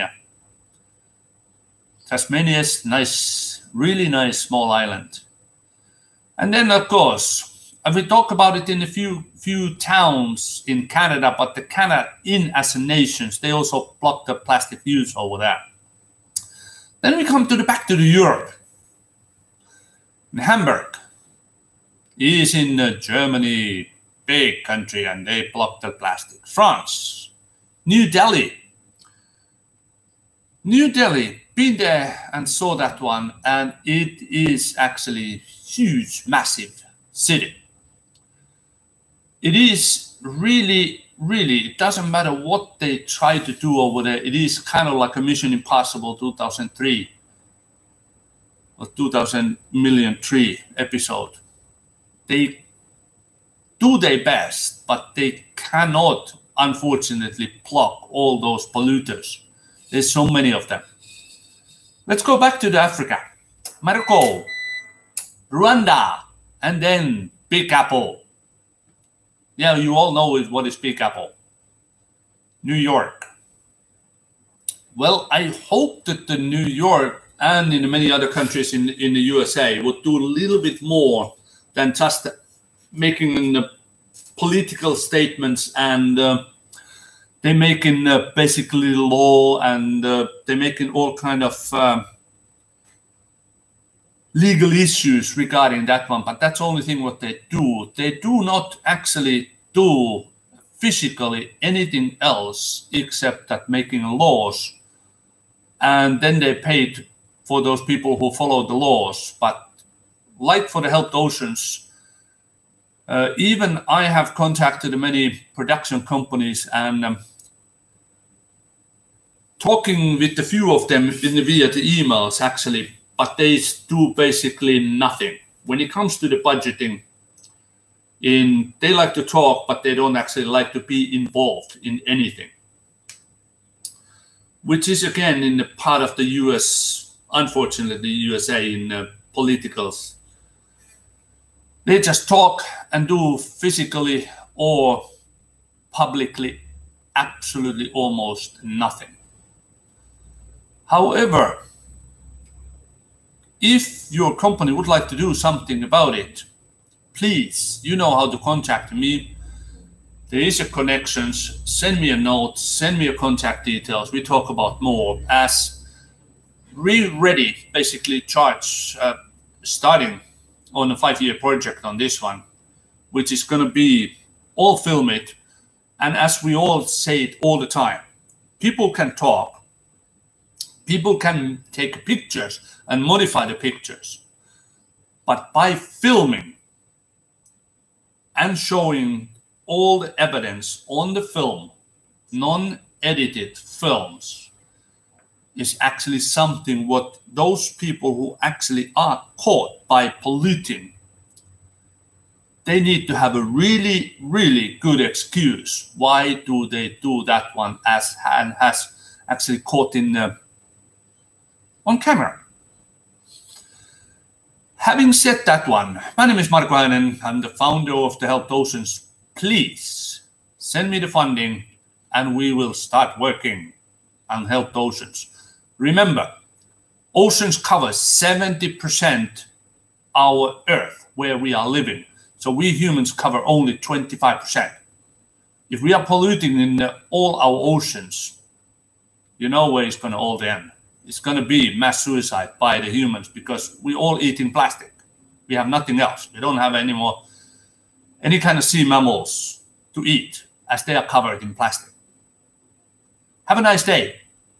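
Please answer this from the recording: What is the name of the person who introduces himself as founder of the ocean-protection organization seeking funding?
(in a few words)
Mark Heinen.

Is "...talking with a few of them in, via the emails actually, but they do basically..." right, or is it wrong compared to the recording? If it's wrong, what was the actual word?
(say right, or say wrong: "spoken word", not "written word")
right.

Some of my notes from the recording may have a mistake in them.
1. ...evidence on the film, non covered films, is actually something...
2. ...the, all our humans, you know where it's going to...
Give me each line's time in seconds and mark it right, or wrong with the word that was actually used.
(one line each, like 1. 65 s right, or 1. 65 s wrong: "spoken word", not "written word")
1. 190 s wrong: "edited", not "covered"
2. 236 s wrong: "oceans", not "humans".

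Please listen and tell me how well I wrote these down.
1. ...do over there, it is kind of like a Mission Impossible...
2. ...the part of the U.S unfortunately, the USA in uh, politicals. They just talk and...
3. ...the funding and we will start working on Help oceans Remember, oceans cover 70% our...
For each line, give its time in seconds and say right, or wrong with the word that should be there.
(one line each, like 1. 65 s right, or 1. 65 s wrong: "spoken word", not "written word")
1. 43 s right
2. 135 s right
3. 220 s right.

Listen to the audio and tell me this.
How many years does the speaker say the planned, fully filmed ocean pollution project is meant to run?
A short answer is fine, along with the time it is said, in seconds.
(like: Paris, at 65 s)
5 years, at 170 s.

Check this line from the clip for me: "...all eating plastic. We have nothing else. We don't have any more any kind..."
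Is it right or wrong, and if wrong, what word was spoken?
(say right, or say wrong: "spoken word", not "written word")
right.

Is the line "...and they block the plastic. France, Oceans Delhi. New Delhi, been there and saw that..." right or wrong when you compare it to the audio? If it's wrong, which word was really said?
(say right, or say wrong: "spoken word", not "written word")
wrong: "New", not "Oceans".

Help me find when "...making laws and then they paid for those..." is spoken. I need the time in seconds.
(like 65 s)
103 s.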